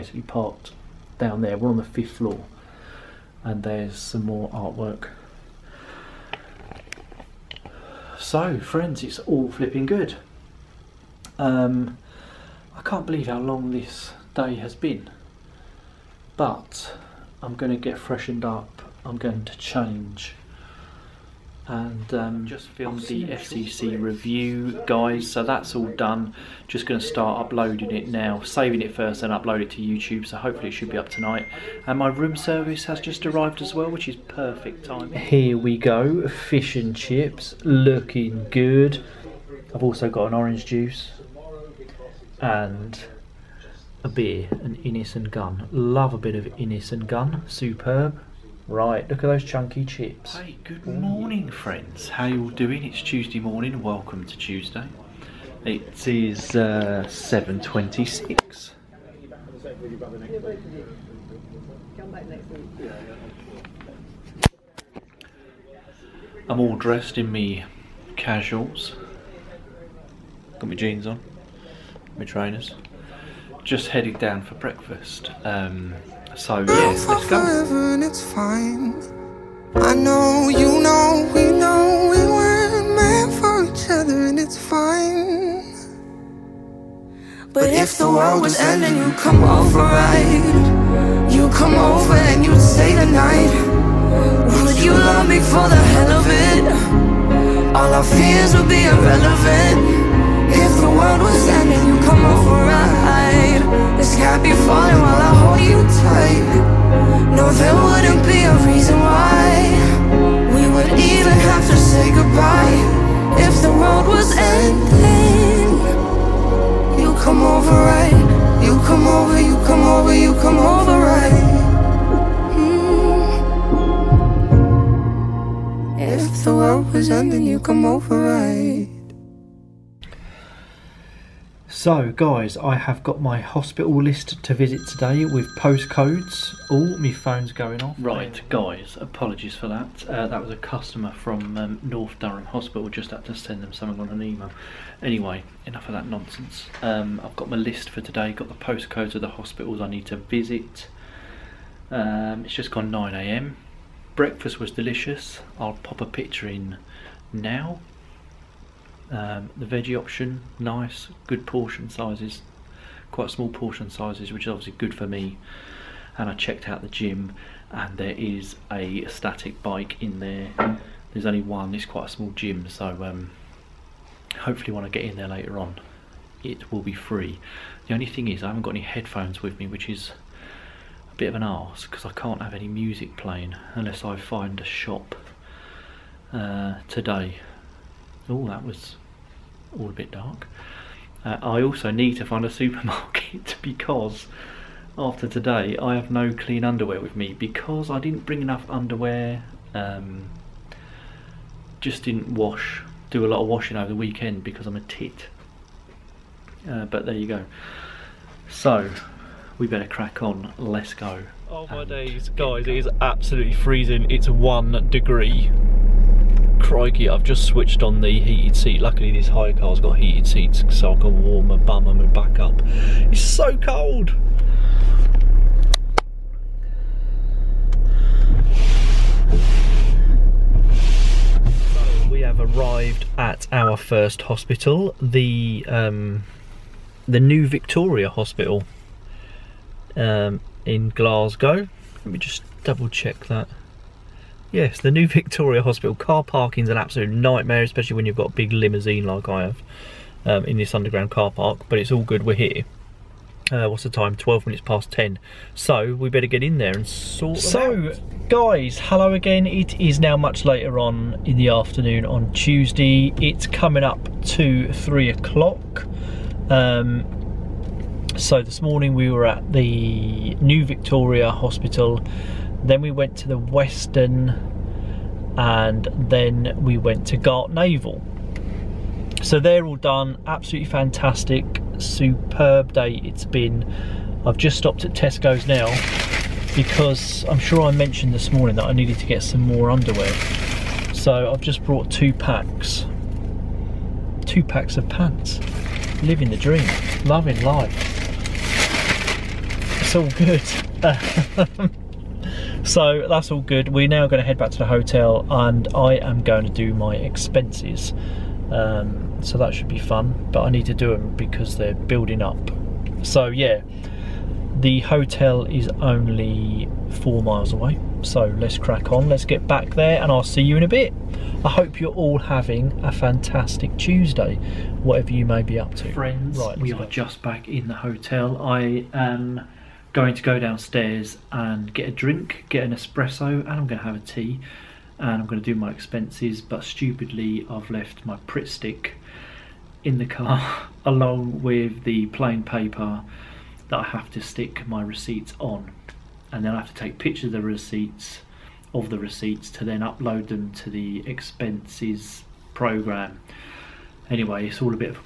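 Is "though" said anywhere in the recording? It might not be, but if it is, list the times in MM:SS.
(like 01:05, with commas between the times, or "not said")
not said.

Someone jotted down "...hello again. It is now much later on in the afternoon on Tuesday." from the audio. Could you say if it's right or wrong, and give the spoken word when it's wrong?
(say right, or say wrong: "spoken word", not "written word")
right.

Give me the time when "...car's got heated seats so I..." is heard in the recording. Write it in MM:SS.
03:39.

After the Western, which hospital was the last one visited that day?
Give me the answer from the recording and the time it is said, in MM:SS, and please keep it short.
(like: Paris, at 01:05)
Gartnavel, at 04:37.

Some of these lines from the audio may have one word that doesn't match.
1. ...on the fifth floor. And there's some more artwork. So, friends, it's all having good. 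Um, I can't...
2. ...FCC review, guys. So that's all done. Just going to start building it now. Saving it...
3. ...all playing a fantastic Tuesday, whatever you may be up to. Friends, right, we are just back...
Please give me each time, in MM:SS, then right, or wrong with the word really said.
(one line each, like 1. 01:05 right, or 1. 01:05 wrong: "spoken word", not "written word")
1. 00:01 wrong: "flipping", not "having"
2. 00:23 wrong: "uploading", not "building"
3. 05:21 wrong: "having", not "playing".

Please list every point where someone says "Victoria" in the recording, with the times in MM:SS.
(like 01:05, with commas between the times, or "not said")
03:57, 04:05, 04:30.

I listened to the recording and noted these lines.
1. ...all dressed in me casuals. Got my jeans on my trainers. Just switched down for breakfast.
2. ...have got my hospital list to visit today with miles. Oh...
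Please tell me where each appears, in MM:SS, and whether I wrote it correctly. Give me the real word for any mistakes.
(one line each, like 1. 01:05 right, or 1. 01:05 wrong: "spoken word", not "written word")
1. 01:06 wrong: "headed", not "switched"
2. 02:12 wrong: "postcodes", not "miles".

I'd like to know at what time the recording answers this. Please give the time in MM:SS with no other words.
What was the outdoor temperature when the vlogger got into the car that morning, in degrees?
03:34.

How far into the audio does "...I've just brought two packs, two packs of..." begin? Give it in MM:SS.
04:51.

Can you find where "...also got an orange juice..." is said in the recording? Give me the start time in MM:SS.
00:39.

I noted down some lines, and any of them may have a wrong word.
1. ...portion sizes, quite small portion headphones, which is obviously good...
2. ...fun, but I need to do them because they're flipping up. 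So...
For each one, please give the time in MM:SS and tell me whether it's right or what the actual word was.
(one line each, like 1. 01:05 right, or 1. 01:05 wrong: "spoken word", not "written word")
1. 02:41 wrong: "sizes", not "headphones"
2. 05:09 wrong: "building", not "flipping".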